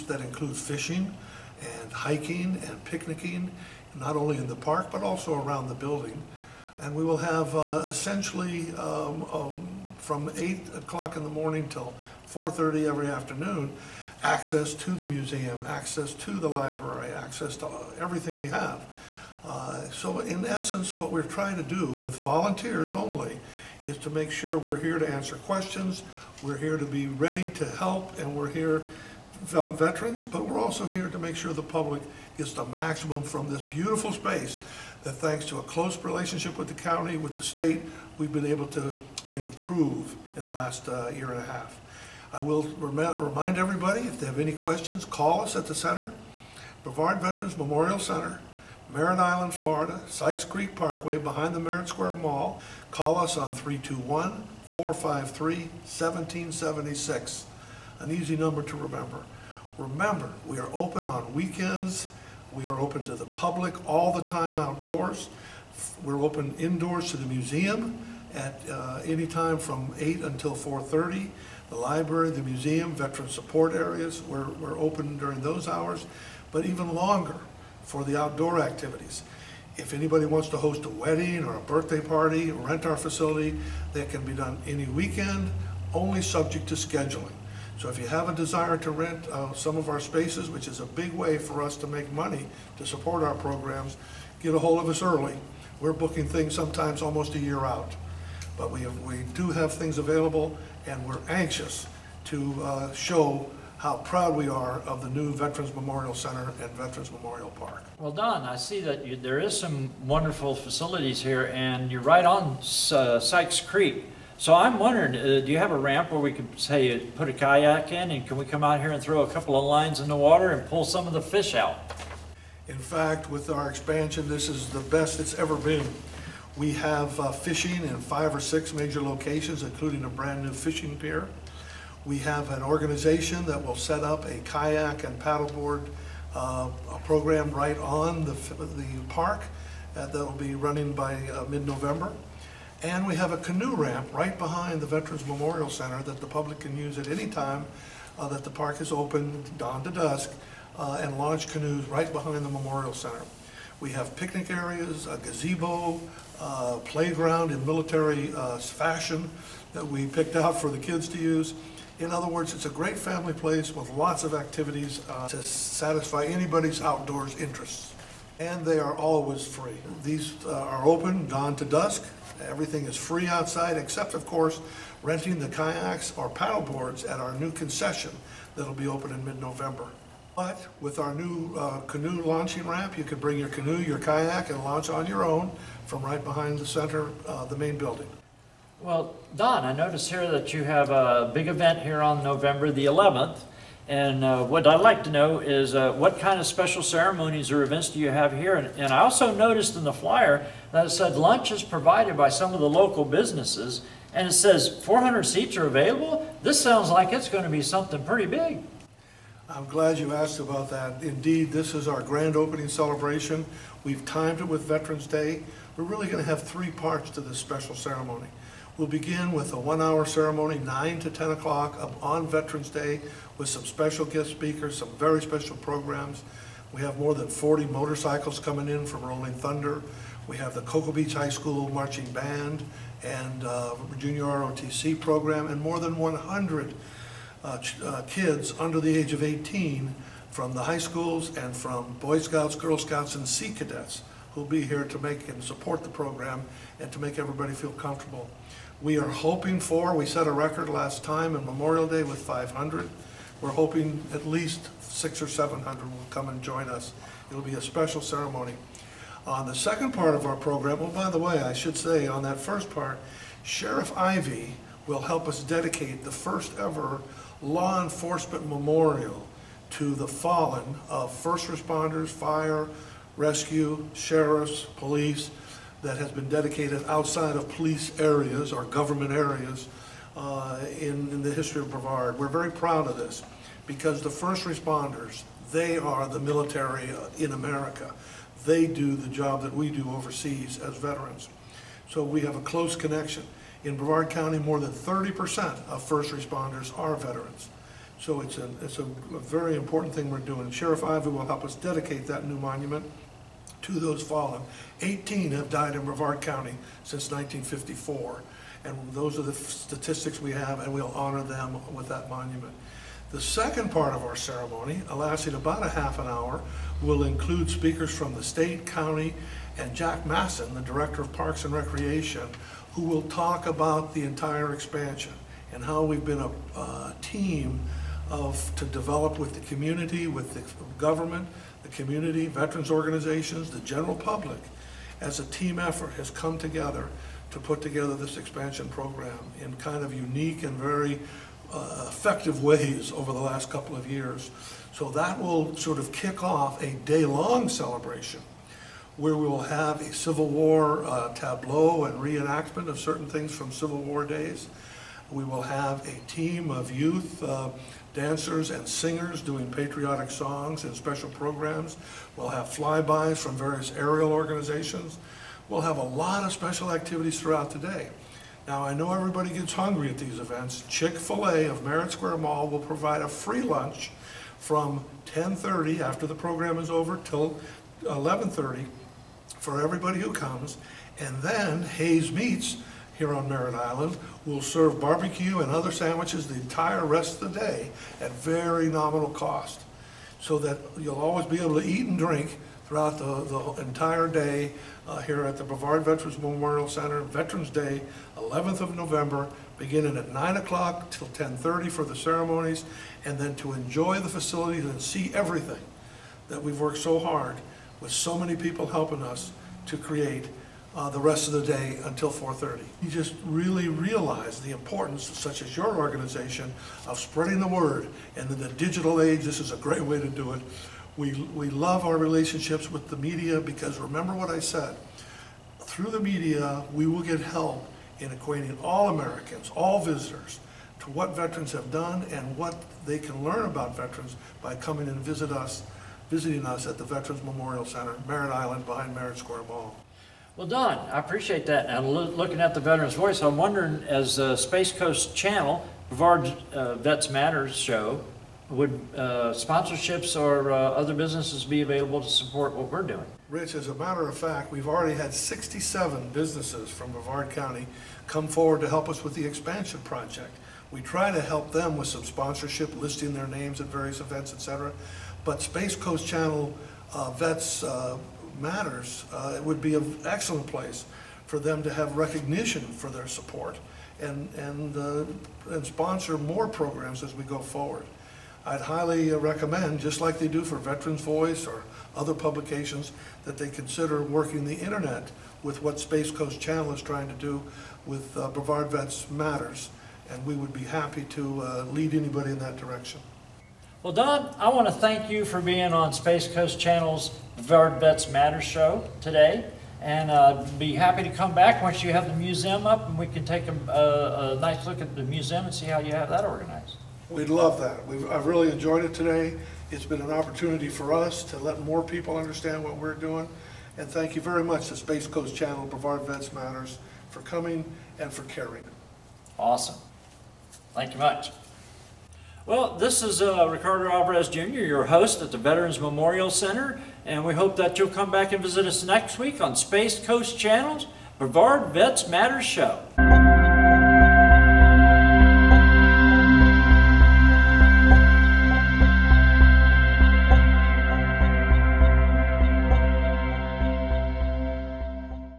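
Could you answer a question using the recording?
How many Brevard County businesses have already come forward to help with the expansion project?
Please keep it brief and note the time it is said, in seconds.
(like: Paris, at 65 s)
67, at 455 s.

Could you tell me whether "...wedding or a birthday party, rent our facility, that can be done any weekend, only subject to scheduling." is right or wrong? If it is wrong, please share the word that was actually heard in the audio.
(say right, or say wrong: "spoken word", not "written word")
right.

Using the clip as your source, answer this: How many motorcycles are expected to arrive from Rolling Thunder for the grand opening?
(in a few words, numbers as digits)
more than 40.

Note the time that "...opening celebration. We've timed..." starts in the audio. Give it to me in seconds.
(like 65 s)
212 s.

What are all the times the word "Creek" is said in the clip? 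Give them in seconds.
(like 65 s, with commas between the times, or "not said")
50 s, 113 s.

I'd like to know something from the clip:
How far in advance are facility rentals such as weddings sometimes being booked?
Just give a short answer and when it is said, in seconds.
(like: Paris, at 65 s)
almost a year, at 97 s.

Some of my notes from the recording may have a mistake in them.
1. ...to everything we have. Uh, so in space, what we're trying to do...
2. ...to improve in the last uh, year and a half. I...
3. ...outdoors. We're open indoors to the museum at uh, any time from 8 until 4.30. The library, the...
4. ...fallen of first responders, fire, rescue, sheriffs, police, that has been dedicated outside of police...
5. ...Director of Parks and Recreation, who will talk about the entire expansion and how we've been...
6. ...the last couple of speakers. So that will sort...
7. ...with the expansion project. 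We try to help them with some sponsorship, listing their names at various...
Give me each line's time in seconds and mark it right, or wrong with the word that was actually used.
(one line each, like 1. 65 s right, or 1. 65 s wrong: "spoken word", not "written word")
1. 17 s wrong: "essence", not "space"
2. 38 s right
3. 64 s right
4. 270 s right
5. 320 s right
6. 343 s wrong: "years", not "speakers"
7. 459 s right.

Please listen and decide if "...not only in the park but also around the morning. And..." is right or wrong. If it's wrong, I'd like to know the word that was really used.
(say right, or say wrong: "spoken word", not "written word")
wrong: "building", not "morning".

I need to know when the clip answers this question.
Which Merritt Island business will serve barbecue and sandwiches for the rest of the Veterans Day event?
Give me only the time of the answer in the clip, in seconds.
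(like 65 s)
381 s.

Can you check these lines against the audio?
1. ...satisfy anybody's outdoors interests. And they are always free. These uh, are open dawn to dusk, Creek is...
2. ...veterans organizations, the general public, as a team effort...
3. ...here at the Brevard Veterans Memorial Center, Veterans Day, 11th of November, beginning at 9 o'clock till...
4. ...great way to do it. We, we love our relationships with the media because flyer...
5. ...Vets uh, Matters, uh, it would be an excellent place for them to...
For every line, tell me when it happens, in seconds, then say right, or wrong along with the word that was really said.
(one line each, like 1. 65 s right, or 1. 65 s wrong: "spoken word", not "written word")
1. 165 s wrong: "Everything", not "Creek"
2. 332 s right
3. 394 s right
4. 419 s wrong: "remember", not "flyer"
5. 467 s right.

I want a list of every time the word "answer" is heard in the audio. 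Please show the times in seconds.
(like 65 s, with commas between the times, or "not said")
25 s.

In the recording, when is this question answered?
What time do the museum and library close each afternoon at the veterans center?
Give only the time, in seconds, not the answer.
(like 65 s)
12 s.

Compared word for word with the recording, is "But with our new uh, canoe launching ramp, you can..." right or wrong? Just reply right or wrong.
right.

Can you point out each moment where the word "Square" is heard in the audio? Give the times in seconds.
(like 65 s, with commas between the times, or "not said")
51 s, 371 s, 439 s.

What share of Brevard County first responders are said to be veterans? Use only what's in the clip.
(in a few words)
more than 30%.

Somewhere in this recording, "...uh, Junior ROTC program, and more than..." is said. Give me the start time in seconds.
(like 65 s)
233 s.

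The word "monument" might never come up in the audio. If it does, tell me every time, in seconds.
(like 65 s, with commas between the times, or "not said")
302 s, 312 s.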